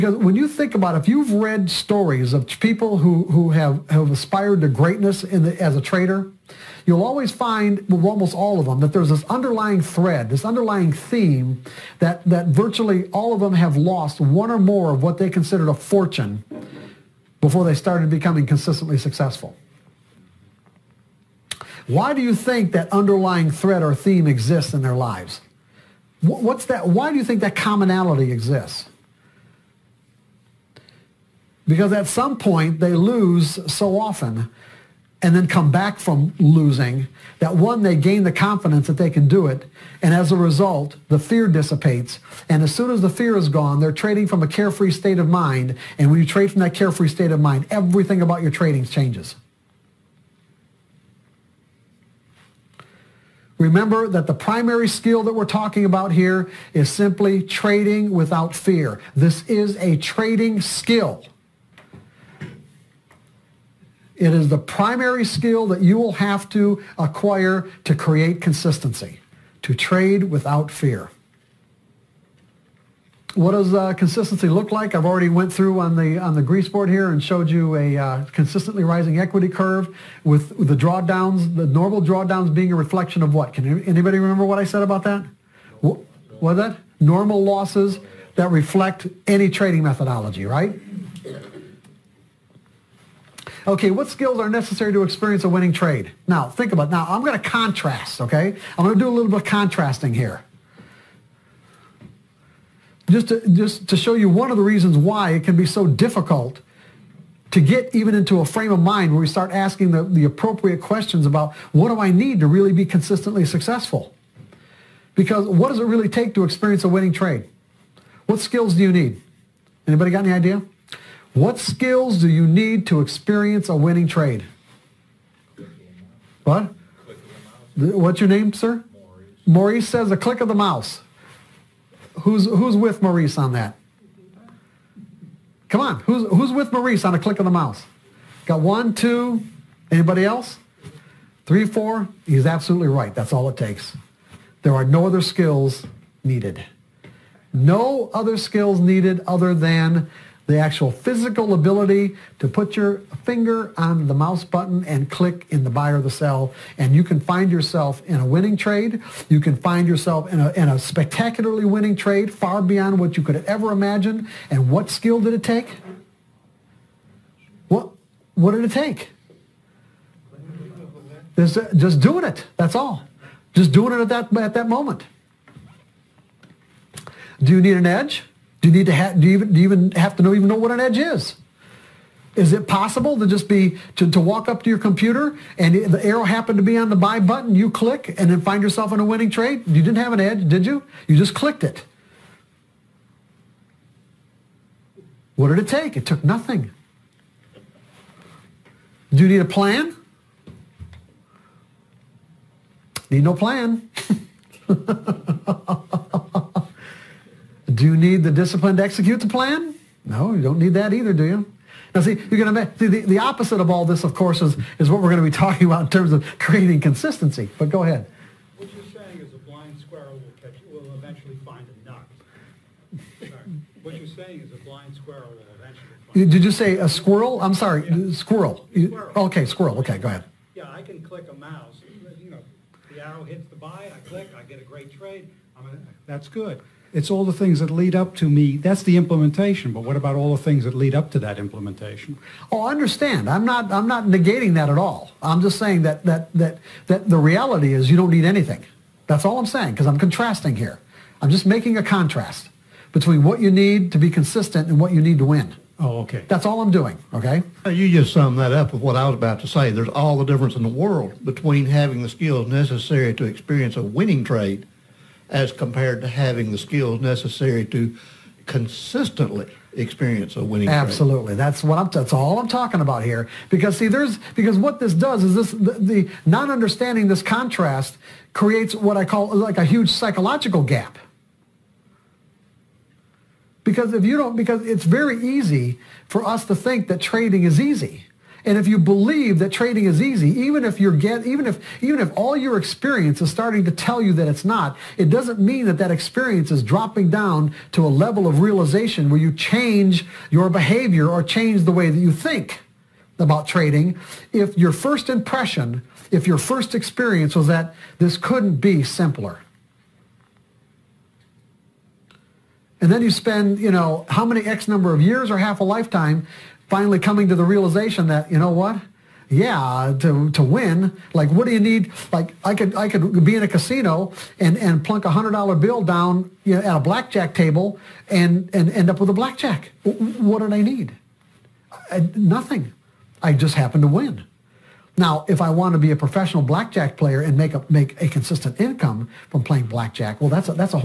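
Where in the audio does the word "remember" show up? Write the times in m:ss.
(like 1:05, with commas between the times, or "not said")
0:53, 1:24.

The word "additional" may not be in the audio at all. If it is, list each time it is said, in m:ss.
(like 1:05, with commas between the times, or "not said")
not said.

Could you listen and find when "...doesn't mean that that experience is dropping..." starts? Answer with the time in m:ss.
4:55.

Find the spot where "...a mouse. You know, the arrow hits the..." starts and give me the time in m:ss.
3:51.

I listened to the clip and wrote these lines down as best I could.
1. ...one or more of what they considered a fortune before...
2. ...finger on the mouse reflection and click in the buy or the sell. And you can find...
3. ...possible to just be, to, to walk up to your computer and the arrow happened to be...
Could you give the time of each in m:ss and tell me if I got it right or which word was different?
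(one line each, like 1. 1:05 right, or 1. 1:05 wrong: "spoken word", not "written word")
1. 0:14 right
2. 2:33 wrong: "button", not "reflection"
3. 3:02 right.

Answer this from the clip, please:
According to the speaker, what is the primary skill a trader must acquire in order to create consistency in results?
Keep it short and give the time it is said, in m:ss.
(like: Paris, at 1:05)
Trading without fear, at 0:57.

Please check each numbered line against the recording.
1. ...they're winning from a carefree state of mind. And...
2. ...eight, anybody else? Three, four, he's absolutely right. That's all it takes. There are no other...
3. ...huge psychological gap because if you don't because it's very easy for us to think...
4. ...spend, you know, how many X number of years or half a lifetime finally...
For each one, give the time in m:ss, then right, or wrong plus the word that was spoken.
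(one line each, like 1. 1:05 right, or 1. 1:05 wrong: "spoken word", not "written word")
1. 0:43 wrong: "trading", not "winning"
2. 2:18 wrong: "two", not "eight"
3. 4:39 right
4. 5:13 right.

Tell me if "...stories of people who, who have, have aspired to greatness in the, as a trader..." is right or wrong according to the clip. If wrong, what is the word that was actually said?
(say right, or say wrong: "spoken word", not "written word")
right.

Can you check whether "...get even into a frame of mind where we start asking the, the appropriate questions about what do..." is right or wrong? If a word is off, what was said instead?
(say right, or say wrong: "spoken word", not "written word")
right.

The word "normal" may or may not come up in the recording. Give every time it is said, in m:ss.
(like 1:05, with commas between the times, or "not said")
1:21, 1:26.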